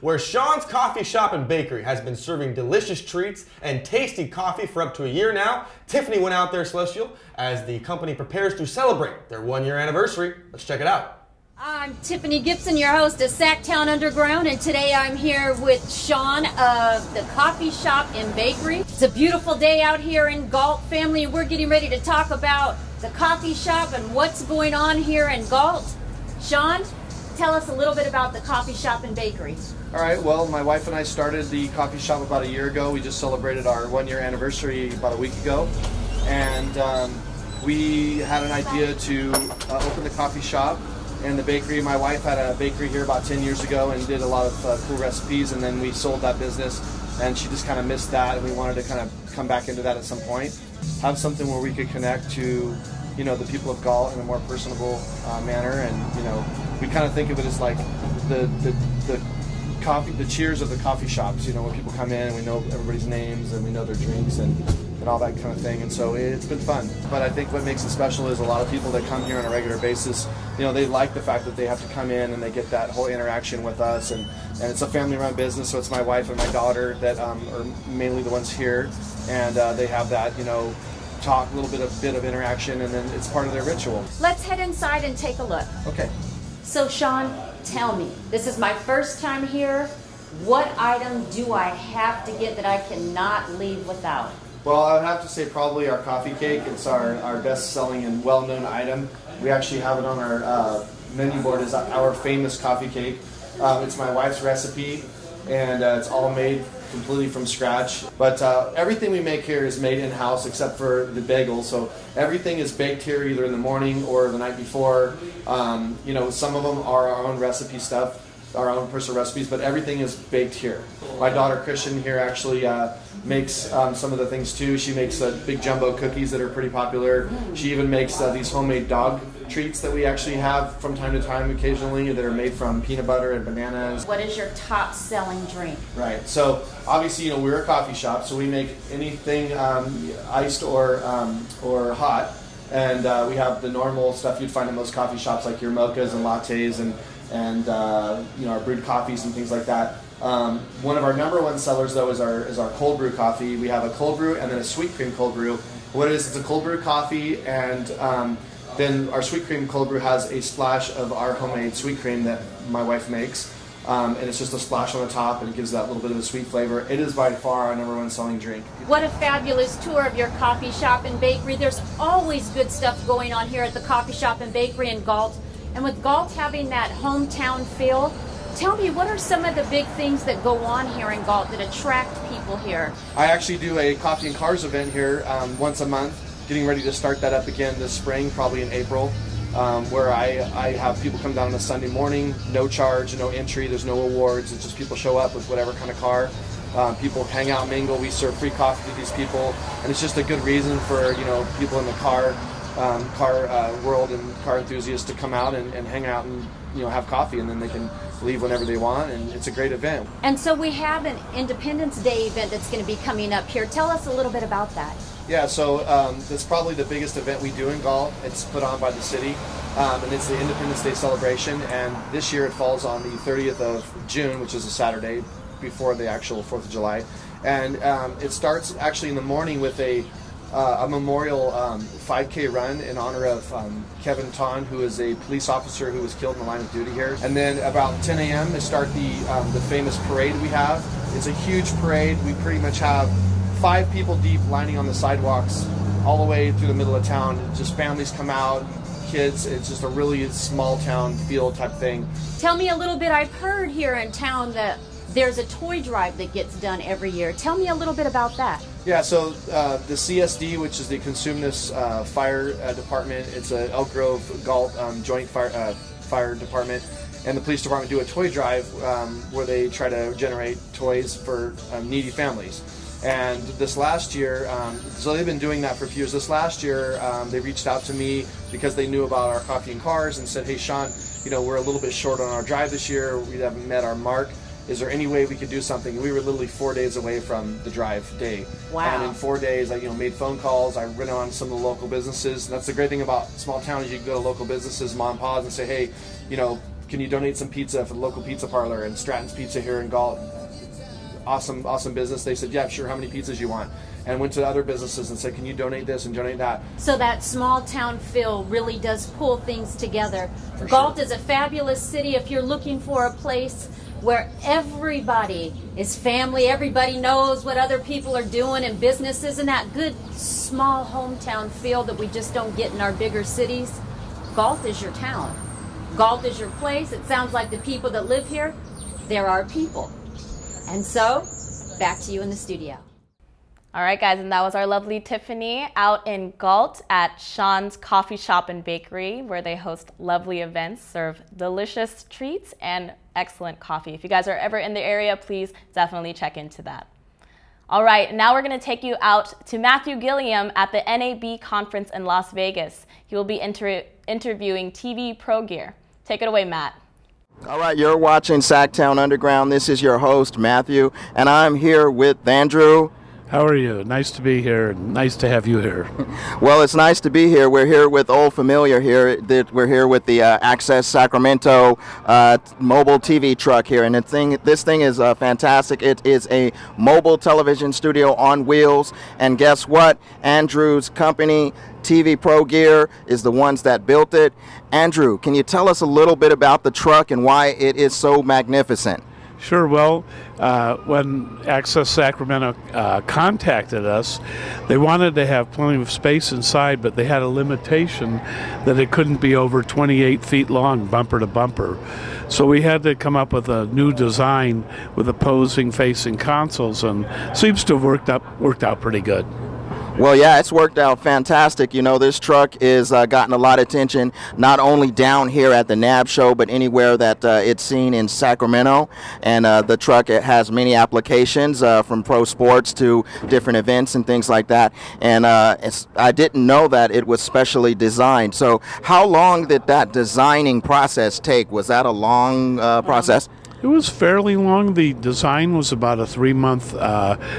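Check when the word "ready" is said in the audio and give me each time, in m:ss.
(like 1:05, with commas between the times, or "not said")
0:21, 3:06.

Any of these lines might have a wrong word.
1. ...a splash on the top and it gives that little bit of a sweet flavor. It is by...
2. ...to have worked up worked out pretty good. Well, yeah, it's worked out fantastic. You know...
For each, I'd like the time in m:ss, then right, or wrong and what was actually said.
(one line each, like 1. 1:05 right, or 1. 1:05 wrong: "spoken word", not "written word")
1. 2:44 right
2. 6:47 right.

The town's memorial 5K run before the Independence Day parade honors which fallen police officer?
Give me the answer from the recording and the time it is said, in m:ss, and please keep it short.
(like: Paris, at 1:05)
Kevin Tonn, at 3:54.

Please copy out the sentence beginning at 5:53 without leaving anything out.
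He will be inter interviewing TV Pro Gear.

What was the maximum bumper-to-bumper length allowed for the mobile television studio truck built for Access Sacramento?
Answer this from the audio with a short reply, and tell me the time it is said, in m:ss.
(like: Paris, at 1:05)
28 feet, at 6:39.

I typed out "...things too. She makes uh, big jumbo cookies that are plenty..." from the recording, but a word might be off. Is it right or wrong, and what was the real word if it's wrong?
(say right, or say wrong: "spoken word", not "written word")
wrong: "pretty", not "plenty".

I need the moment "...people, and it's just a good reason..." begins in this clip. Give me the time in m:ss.
3:19.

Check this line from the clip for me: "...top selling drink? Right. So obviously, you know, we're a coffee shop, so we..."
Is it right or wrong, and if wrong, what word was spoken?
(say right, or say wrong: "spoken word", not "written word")
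right.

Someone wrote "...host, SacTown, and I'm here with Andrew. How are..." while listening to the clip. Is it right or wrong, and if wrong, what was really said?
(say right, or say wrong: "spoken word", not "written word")
wrong: "Matthew", not "SacTown".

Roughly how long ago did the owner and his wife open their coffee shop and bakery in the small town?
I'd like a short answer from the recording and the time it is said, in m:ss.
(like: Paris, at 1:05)
about a year ago, at 0:32.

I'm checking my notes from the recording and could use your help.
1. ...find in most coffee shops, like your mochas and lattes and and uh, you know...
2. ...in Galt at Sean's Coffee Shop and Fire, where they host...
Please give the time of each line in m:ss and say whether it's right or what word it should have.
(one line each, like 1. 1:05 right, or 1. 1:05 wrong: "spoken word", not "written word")
1. 2:24 right
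2. 5:36 wrong: "Bakery", not "Fire".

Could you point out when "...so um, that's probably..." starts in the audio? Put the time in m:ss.
3:35.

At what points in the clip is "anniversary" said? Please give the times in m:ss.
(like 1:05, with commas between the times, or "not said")
0:09, 0:34.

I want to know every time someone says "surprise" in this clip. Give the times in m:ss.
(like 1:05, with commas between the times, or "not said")
not said.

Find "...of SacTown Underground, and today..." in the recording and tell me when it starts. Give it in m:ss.
0:13.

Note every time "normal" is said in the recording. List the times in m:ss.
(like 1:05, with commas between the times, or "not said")
2:23.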